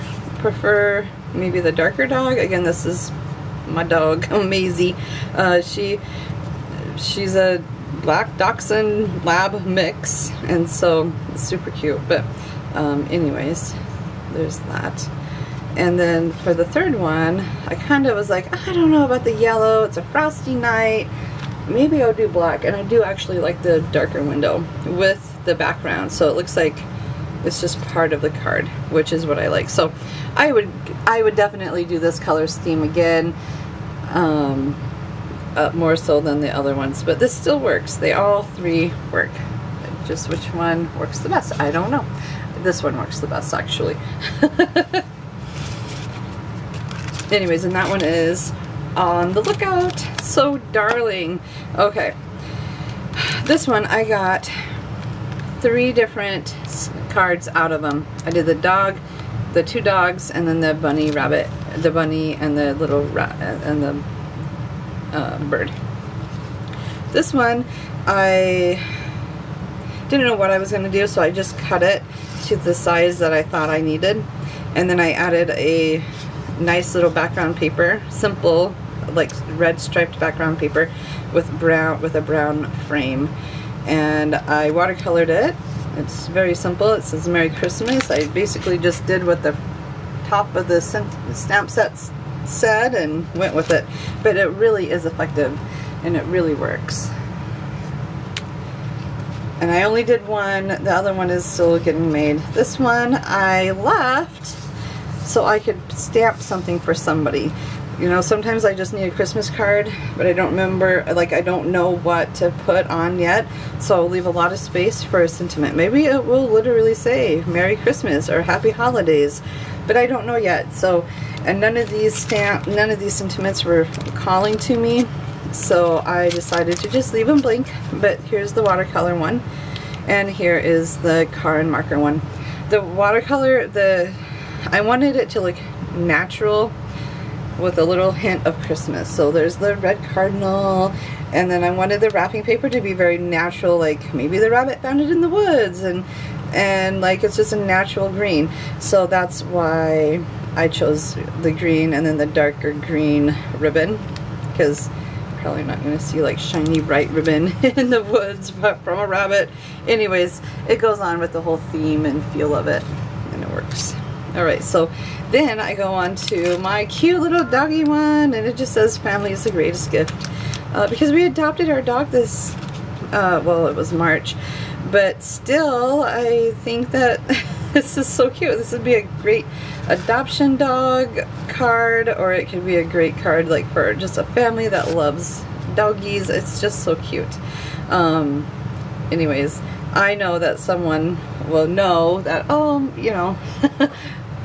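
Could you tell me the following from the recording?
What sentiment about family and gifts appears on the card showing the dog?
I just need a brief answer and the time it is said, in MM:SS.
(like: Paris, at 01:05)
Family is the greatest gift, at 02:48.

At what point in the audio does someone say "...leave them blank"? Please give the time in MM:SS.
02:07.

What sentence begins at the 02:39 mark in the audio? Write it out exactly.
Anyways, it goes on with the whole theme and feel of it and it works.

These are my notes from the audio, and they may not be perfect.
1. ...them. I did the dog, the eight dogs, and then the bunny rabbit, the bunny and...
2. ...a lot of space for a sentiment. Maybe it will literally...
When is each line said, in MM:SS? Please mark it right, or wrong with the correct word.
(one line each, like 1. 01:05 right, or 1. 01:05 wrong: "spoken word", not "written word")
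1. 00:57 wrong: "two", not "eight"
2. 01:54 right.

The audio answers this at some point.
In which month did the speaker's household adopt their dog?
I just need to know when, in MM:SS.
02:53.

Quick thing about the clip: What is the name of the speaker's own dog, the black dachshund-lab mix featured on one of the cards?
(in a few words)
Maisie.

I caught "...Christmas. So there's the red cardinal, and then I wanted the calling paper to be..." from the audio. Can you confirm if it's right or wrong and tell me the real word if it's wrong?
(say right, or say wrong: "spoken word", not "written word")
wrong: "wrapping", not "calling".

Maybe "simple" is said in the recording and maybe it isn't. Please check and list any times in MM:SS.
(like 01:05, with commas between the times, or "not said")
01:18, 01:26.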